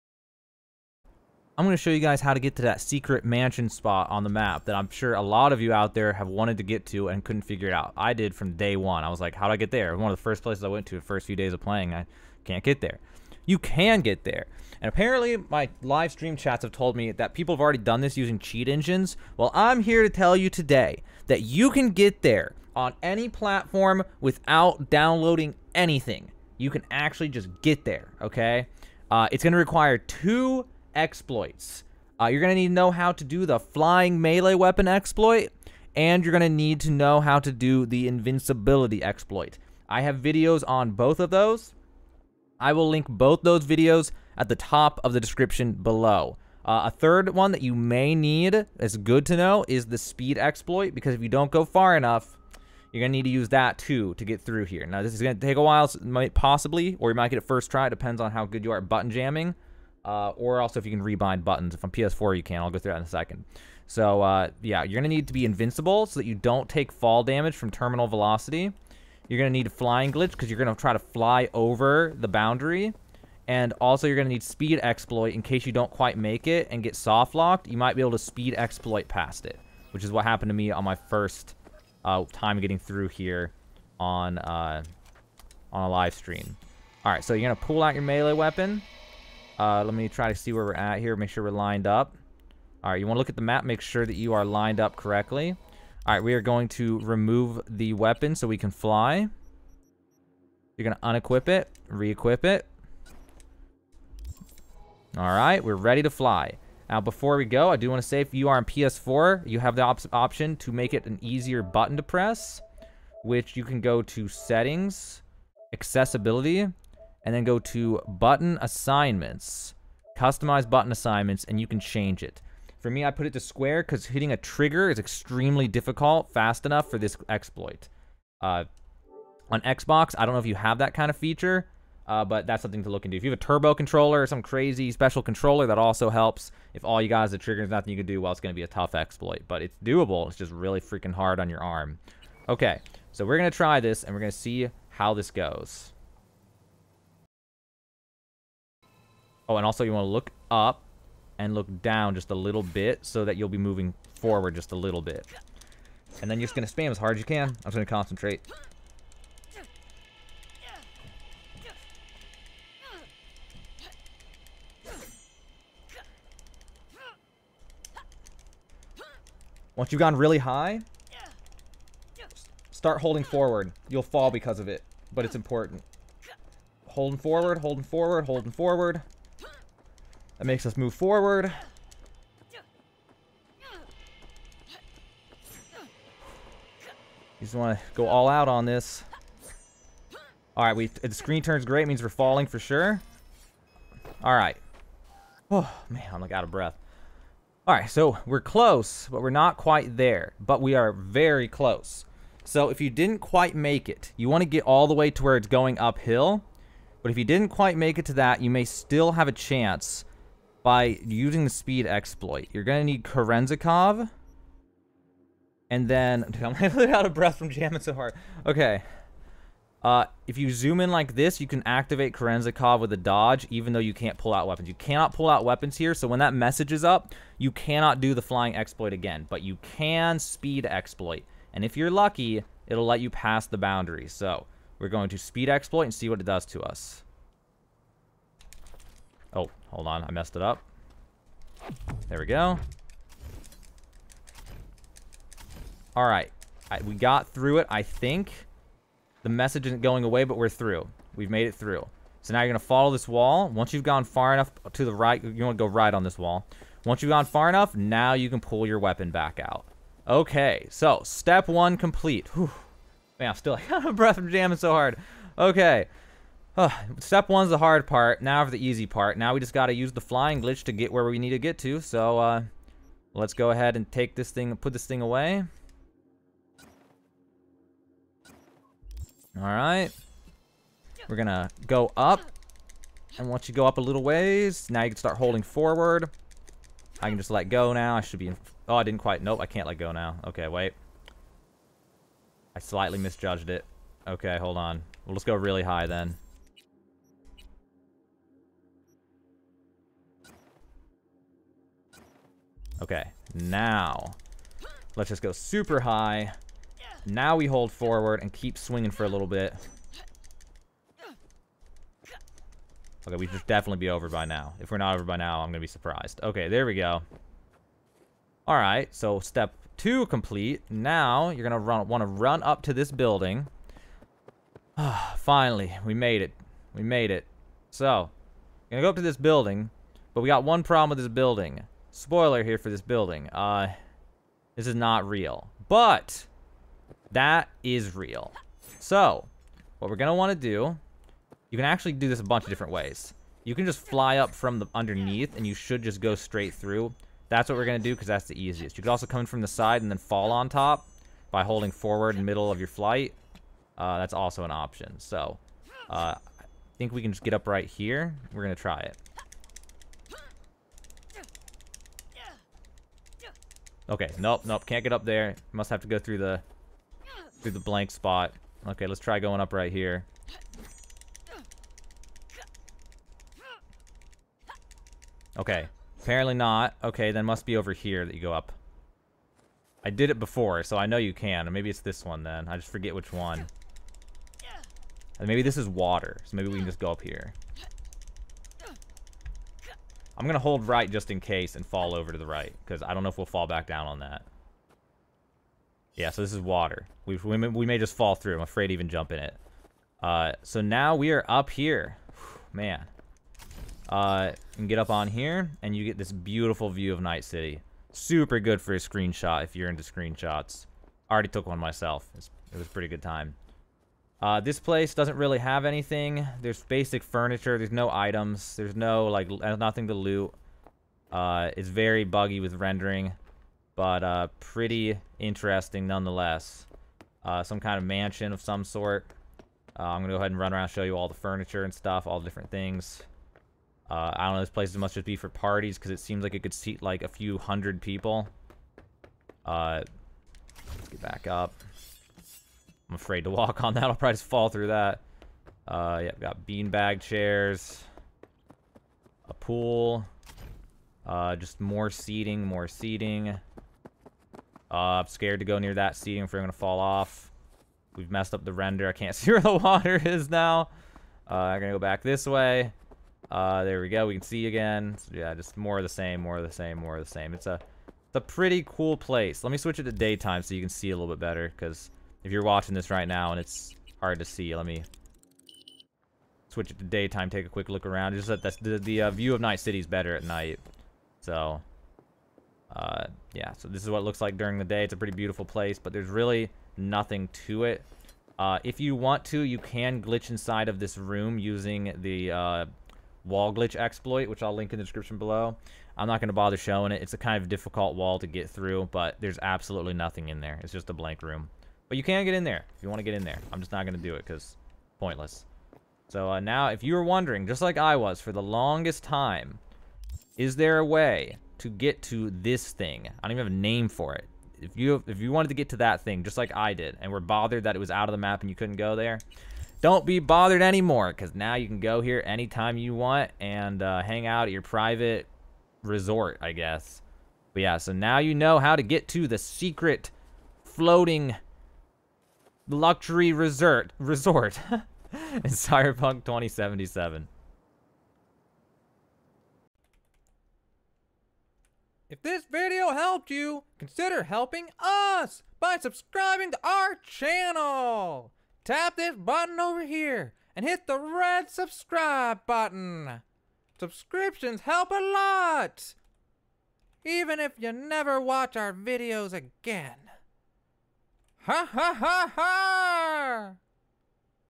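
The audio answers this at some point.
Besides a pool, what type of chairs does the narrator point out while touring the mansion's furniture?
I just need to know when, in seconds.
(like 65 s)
446 s.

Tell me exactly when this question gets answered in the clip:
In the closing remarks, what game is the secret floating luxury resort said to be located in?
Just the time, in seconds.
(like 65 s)
535 s.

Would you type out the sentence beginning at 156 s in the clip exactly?
And then you're just going to spam as hard as you can.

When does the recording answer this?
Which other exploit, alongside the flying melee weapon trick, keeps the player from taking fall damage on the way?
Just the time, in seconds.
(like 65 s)
38 s.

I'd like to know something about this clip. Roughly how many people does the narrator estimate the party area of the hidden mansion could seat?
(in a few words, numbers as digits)
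A few hundred.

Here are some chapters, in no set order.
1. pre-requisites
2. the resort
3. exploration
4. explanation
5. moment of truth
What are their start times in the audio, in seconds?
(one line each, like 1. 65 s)
1. 29 s
2. 375 s
3. 280 s
4. 64 s
5. 147 s.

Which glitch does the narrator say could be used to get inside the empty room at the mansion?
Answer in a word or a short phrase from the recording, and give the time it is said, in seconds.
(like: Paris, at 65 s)
Wall glitch exploit, at 493 s.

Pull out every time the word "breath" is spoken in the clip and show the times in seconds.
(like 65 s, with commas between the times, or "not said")
196 s, 217 s, 263 s.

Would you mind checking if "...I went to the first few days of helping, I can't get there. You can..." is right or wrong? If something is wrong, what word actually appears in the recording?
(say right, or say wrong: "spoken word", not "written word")
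wrong: "playing", not "helping".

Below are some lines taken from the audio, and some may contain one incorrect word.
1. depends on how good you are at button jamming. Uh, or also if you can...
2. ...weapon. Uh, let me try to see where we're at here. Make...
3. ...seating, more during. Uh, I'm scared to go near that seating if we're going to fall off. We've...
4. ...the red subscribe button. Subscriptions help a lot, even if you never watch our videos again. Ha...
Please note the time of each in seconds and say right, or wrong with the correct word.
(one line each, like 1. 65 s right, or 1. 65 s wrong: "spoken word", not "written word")
1. 57 s right
2. 88 s right
3. 451 s wrong: "seating", not "during"
4. 550 s right.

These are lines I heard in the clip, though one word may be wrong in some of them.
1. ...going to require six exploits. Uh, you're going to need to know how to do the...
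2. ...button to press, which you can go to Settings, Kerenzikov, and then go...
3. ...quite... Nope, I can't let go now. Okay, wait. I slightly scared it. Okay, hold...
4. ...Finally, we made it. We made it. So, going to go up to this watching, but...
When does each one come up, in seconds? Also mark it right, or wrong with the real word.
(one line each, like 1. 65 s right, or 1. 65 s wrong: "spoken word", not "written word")
1. 29 s wrong: "two", not "six"
2. 111 s wrong: "Accessibility", not "Kerenzikov"
3. 289 s wrong: "misjudged", not "scared"
4. 325 s wrong: "building", not "watching".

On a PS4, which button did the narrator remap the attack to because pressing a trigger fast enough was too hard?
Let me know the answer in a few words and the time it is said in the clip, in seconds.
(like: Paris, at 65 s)
Square, at 123 s.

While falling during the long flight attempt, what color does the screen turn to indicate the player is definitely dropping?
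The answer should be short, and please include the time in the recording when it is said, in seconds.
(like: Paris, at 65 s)
Gray, at 191 s.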